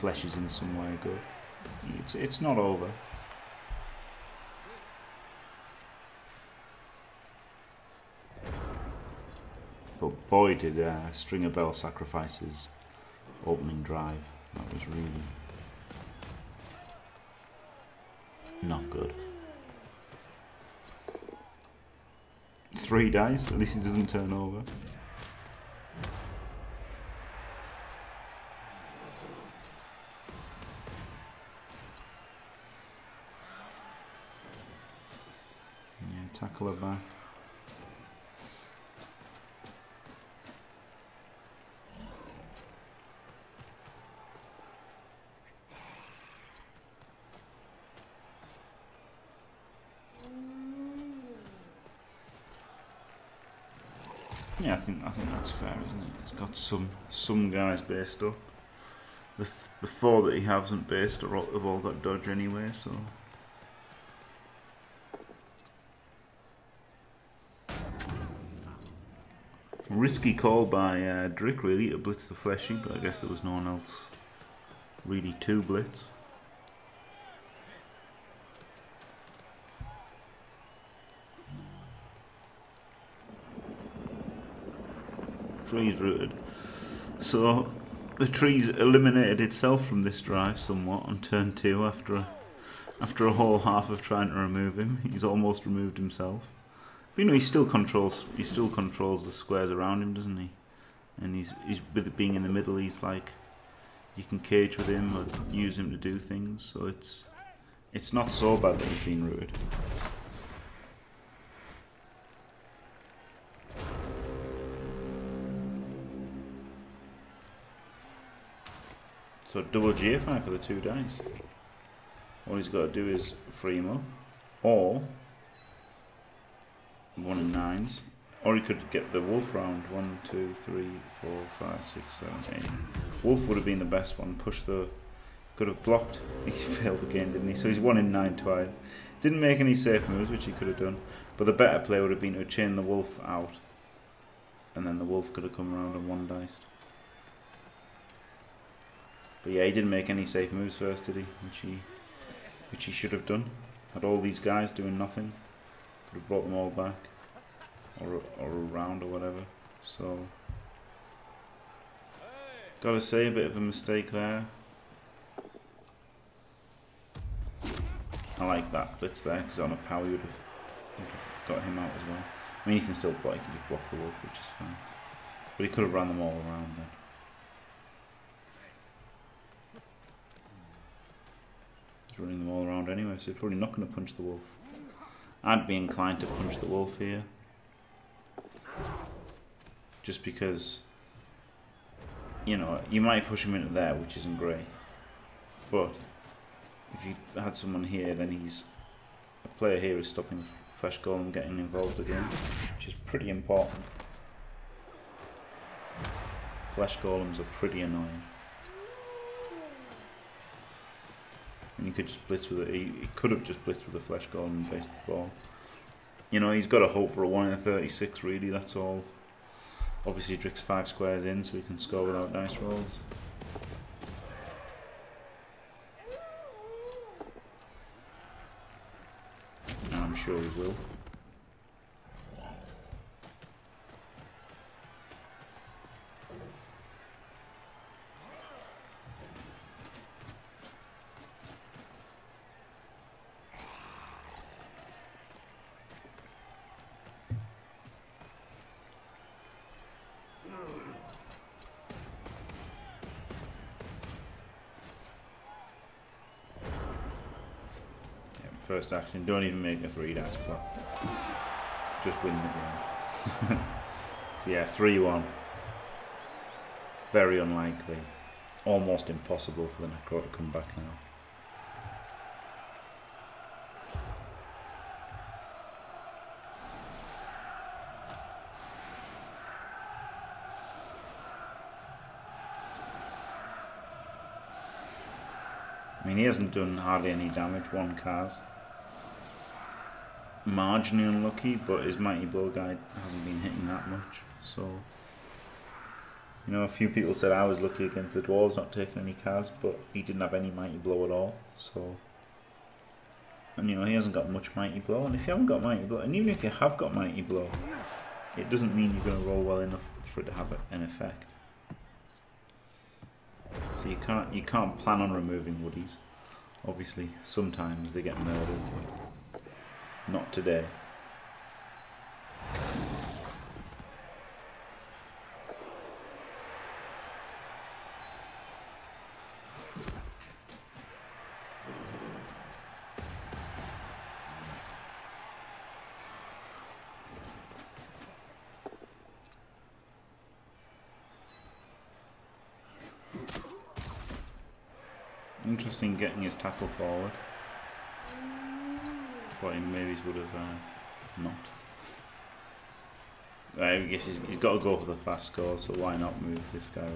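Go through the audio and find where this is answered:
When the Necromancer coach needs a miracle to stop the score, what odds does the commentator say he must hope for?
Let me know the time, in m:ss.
3:37.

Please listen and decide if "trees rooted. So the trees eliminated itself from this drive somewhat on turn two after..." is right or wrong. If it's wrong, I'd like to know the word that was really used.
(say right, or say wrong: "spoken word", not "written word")
right.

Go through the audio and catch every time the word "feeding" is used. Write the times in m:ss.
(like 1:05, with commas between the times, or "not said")
not said.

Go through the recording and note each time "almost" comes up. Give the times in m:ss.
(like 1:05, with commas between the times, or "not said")
1:35, 4:28.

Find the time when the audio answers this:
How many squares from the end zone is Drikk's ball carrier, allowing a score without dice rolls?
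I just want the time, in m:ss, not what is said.
3:40.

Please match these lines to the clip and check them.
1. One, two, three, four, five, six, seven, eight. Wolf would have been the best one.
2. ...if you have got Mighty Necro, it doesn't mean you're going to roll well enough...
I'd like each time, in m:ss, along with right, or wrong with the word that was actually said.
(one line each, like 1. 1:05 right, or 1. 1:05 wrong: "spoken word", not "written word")
1. 2:09 right
2. 5:06 wrong: "Blow", not "Necro".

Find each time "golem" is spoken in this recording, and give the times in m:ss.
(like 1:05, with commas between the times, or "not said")
3:20, 3:26, 3:34.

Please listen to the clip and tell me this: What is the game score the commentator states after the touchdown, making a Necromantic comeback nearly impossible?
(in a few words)
3-1.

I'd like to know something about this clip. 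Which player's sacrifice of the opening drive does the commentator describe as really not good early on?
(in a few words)
Stringer Bell.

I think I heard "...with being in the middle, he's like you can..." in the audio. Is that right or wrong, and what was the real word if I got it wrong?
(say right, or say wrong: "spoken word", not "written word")
right.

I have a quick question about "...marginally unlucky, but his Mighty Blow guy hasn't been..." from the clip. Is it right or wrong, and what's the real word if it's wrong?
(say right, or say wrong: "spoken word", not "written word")
right.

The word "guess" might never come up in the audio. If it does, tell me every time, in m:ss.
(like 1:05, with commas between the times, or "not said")
1:12, 5:53.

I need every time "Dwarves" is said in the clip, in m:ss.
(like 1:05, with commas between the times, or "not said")
4:58.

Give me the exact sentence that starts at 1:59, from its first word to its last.
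So double GFI for the two dice.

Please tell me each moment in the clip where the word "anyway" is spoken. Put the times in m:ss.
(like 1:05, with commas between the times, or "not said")
1:02, 3:02.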